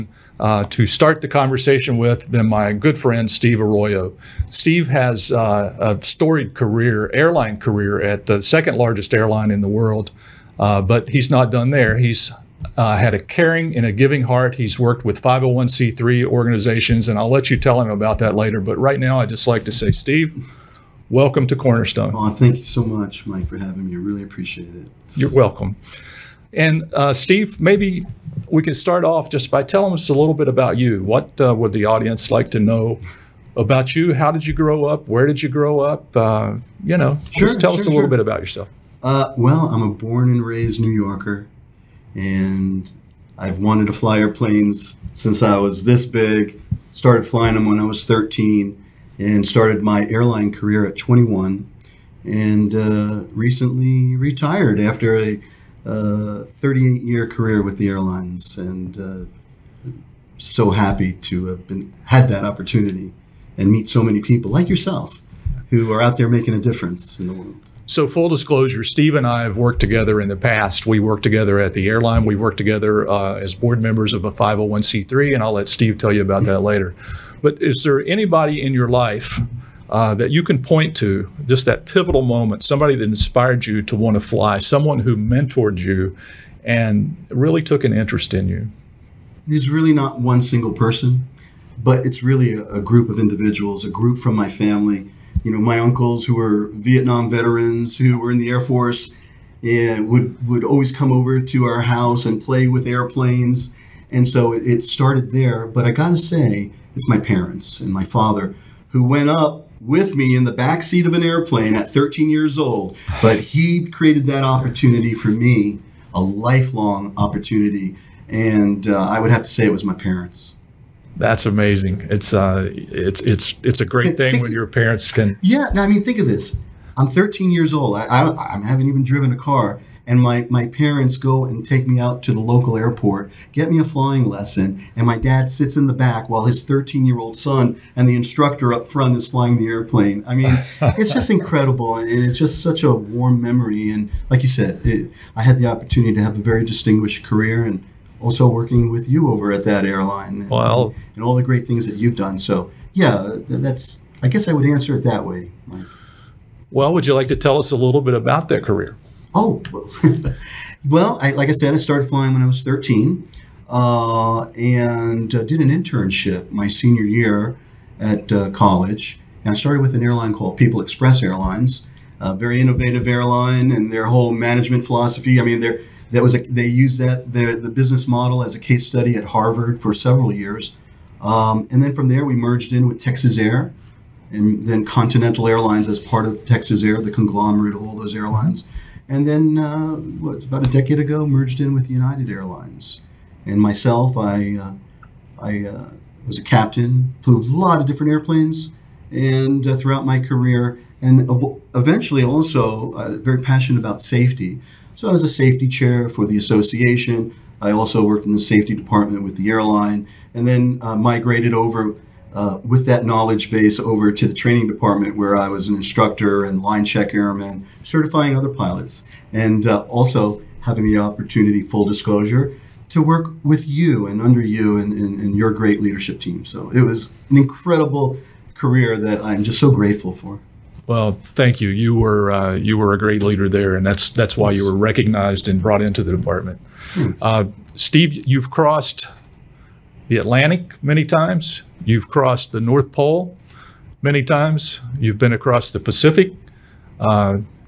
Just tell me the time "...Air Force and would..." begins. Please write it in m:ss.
1:38.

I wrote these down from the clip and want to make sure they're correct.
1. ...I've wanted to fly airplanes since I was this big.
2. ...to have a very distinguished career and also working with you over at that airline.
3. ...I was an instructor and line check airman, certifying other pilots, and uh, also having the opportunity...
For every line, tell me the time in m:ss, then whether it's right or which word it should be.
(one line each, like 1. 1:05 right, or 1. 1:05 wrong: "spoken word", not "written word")
1. 0:43 right
2. 2:26 right
3. 3:35 right.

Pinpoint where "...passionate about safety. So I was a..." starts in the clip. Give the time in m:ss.
3:23.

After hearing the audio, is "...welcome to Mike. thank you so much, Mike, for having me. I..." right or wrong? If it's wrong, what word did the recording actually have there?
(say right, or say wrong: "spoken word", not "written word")
wrong: "Cornerstone", not "Mike".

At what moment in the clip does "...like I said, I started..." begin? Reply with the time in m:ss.
2:41.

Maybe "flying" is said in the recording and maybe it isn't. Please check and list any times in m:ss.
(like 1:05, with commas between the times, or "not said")
0:47, 2:13, 2:19, 2:42.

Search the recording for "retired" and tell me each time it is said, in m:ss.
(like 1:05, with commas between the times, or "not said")
0:54.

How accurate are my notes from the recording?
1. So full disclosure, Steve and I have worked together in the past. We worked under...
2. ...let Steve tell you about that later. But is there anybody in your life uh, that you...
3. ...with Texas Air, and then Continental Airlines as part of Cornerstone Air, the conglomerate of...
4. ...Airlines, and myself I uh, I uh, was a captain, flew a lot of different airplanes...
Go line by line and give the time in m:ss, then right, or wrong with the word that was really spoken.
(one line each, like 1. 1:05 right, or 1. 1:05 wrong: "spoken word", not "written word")
1. 1:07 wrong: "together", not "under"
2. 1:15 right
3. 3:02 wrong: "Texas", not "Cornerstone"
4. 3:12 right.